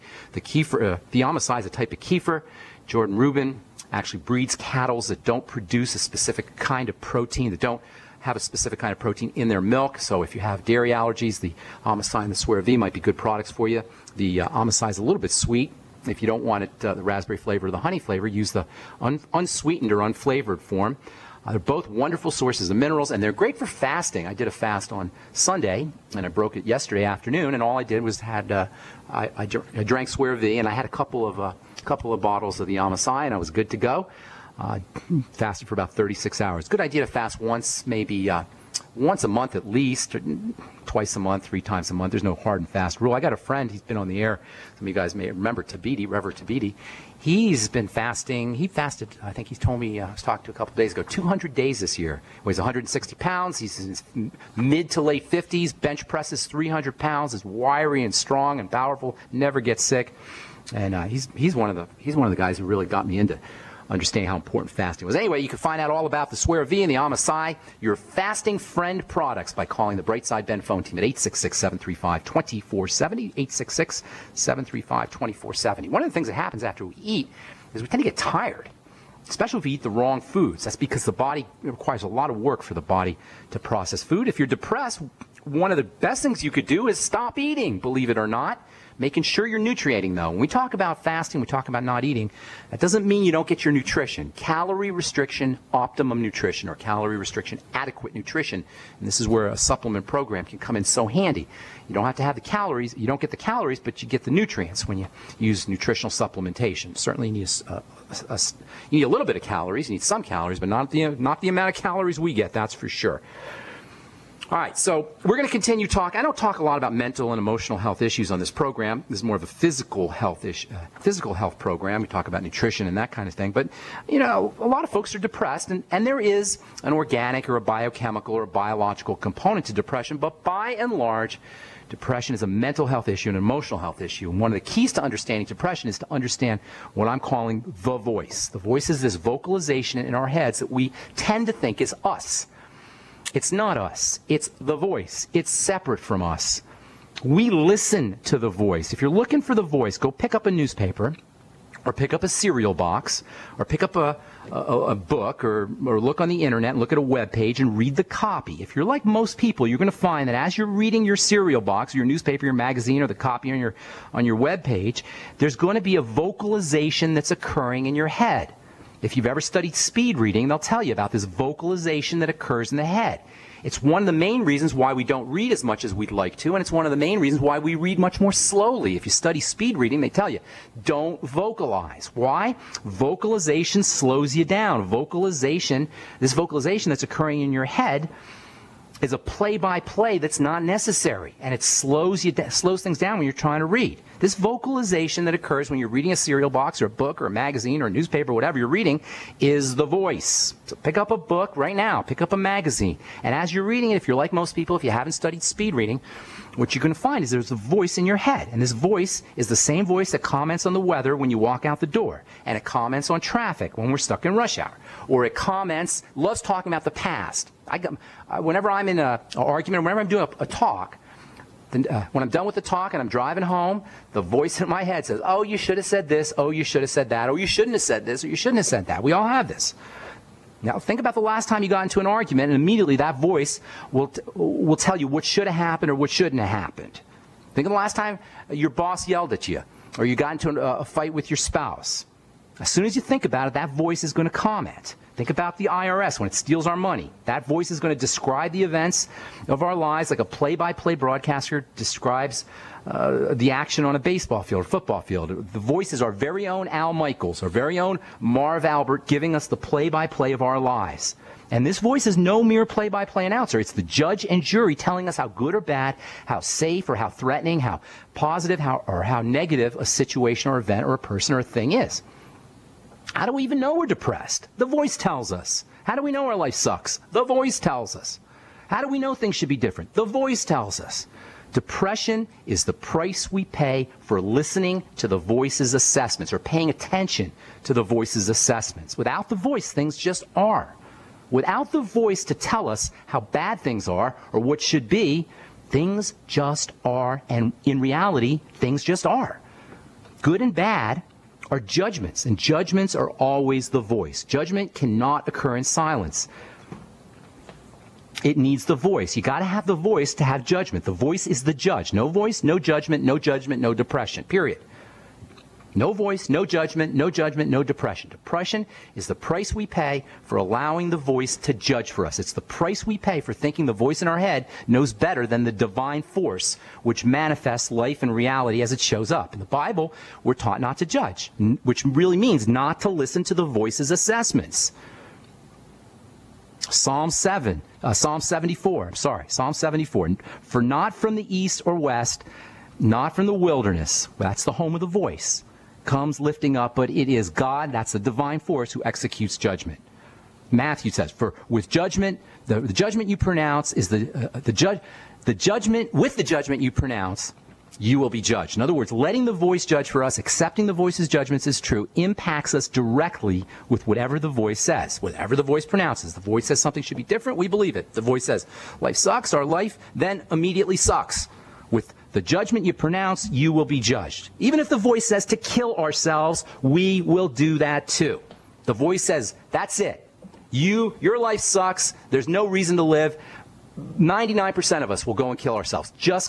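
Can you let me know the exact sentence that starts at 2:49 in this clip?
If you've ever studied speed reading, they'll tell you about this vocalization that occurs in the head.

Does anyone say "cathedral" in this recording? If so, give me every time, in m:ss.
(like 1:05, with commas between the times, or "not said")
not said.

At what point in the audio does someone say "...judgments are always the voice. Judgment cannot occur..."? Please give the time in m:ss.
5:02.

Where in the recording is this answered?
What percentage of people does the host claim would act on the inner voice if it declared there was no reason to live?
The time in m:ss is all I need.
6:23.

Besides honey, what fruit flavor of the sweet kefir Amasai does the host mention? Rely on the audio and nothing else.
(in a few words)
Raspberry.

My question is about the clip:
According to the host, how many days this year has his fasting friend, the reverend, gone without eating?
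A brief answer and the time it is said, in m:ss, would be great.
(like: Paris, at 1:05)
200 days, at 0:51.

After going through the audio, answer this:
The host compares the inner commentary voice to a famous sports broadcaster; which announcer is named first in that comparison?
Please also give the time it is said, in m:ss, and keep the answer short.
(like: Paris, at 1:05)
Al Michaels, at 4:16.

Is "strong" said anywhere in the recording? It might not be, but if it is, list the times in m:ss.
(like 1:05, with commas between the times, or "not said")
0:58.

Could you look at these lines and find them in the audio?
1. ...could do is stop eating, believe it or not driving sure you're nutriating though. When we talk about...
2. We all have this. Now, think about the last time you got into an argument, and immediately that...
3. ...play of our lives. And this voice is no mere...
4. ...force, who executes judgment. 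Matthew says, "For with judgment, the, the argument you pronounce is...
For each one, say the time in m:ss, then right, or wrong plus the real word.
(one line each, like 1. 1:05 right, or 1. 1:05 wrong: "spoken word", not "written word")
1. 1:26 wrong: "making", not "driving"
2. 3:49 right
3. 4:20 right
4. 5:48 wrong: "judgment", not "argument".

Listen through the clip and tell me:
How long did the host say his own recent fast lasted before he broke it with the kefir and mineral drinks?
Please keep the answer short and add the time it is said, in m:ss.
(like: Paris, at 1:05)
36 hours, at 0:35.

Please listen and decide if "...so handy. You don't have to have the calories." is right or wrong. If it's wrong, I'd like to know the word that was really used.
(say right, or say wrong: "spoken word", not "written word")
right.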